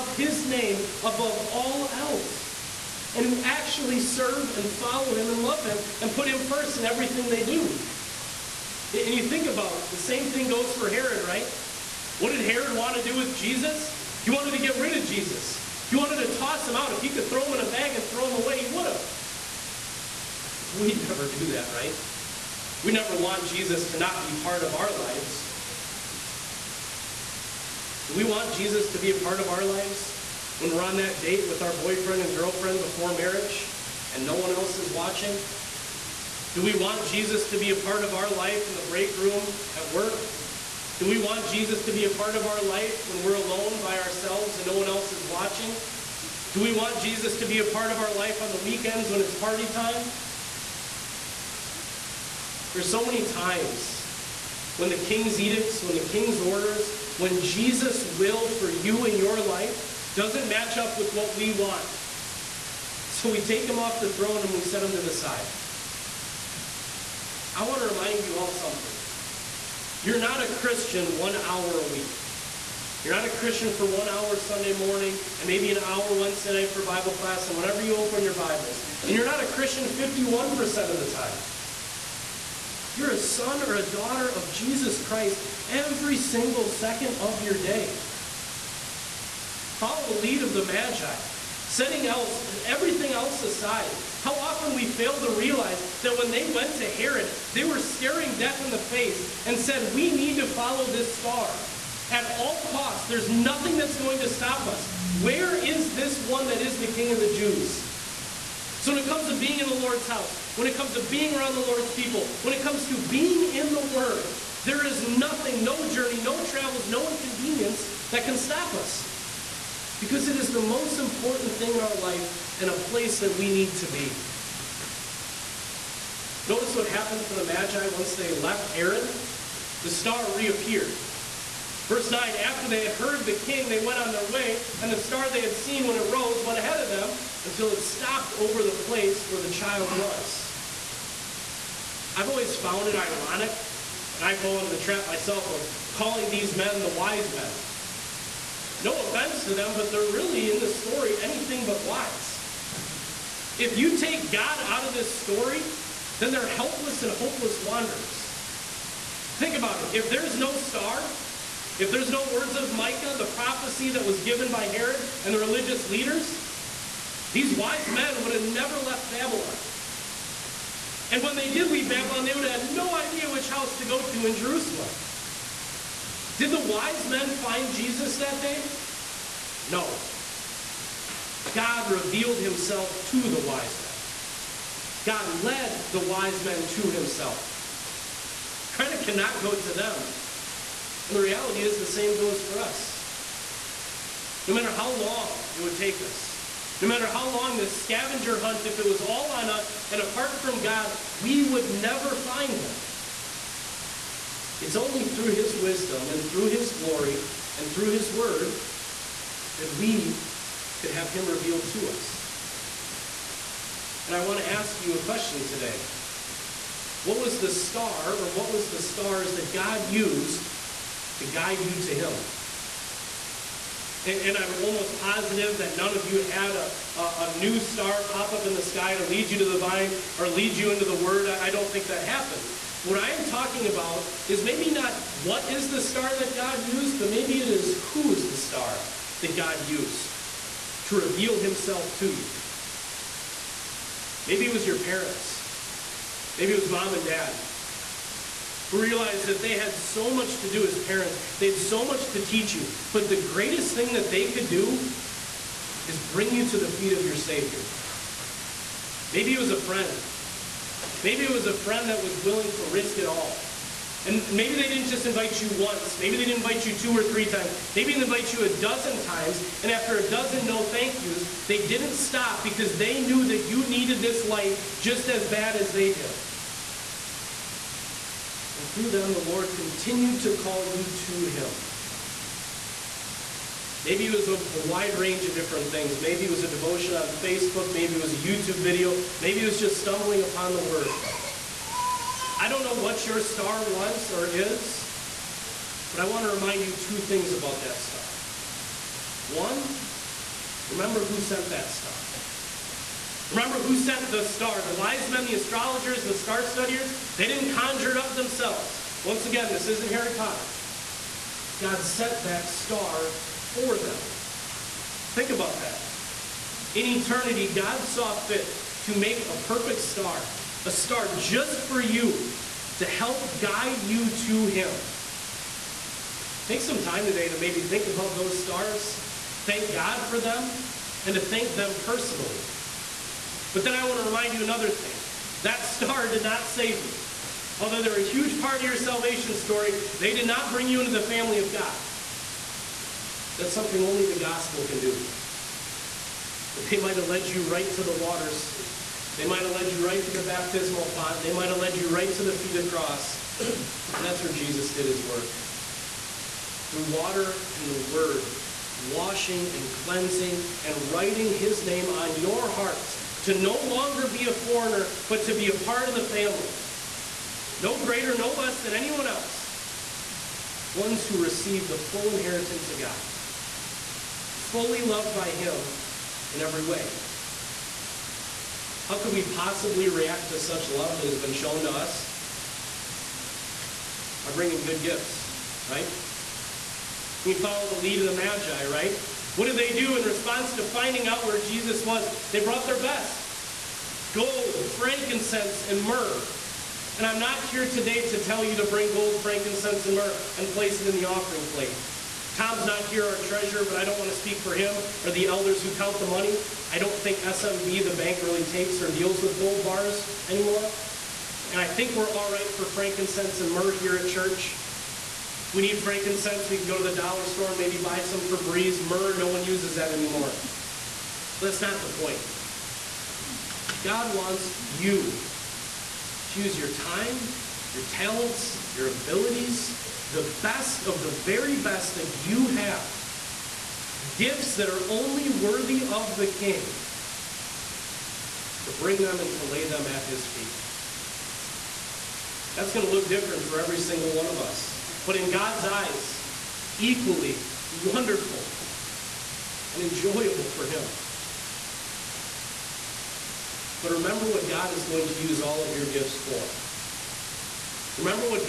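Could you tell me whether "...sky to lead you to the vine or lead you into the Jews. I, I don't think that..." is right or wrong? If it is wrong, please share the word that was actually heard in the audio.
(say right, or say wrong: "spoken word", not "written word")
wrong: "Word", not "Jews".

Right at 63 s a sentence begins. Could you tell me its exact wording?
So we take him off the throne and we set him to the side.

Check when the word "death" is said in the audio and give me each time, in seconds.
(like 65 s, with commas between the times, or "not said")
98 s.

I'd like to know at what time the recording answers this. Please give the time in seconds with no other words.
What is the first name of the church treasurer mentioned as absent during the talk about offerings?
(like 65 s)
402 s.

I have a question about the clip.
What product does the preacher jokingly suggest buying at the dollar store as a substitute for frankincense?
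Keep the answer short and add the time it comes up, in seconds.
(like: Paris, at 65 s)
Febreze, at 418 s.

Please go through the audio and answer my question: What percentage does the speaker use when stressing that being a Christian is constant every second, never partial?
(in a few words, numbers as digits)
51%.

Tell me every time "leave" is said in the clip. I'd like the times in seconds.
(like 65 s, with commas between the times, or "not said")
171 s.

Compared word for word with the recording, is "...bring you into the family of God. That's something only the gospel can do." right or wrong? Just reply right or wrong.
right.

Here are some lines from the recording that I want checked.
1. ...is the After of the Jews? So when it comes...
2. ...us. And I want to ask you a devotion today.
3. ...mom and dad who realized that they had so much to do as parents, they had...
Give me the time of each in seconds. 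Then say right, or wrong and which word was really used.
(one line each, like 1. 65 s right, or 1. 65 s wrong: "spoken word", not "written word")
1. 106 s wrong: "King", not "After"
2. 211 s wrong: "question", not "devotion"
3. 246 s right.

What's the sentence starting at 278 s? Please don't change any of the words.
And through them, the Lord continued to call you to Him.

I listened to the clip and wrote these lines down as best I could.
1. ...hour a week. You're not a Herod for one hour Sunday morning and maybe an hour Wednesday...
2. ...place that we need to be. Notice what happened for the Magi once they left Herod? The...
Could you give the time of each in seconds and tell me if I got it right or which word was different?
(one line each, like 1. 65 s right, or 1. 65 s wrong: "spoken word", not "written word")
1. 71 s wrong: "Christian", not "Herod"
2. 122 s right.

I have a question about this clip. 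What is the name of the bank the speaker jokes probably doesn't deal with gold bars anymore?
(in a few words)
SMB.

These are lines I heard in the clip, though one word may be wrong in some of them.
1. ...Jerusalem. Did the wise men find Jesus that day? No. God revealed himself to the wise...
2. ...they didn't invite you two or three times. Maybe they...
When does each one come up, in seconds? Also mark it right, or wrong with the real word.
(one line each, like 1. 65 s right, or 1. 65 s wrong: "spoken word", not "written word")
1. 174 s right
2. 266 s right.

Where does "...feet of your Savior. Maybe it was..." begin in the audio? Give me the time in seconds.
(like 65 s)
256 s.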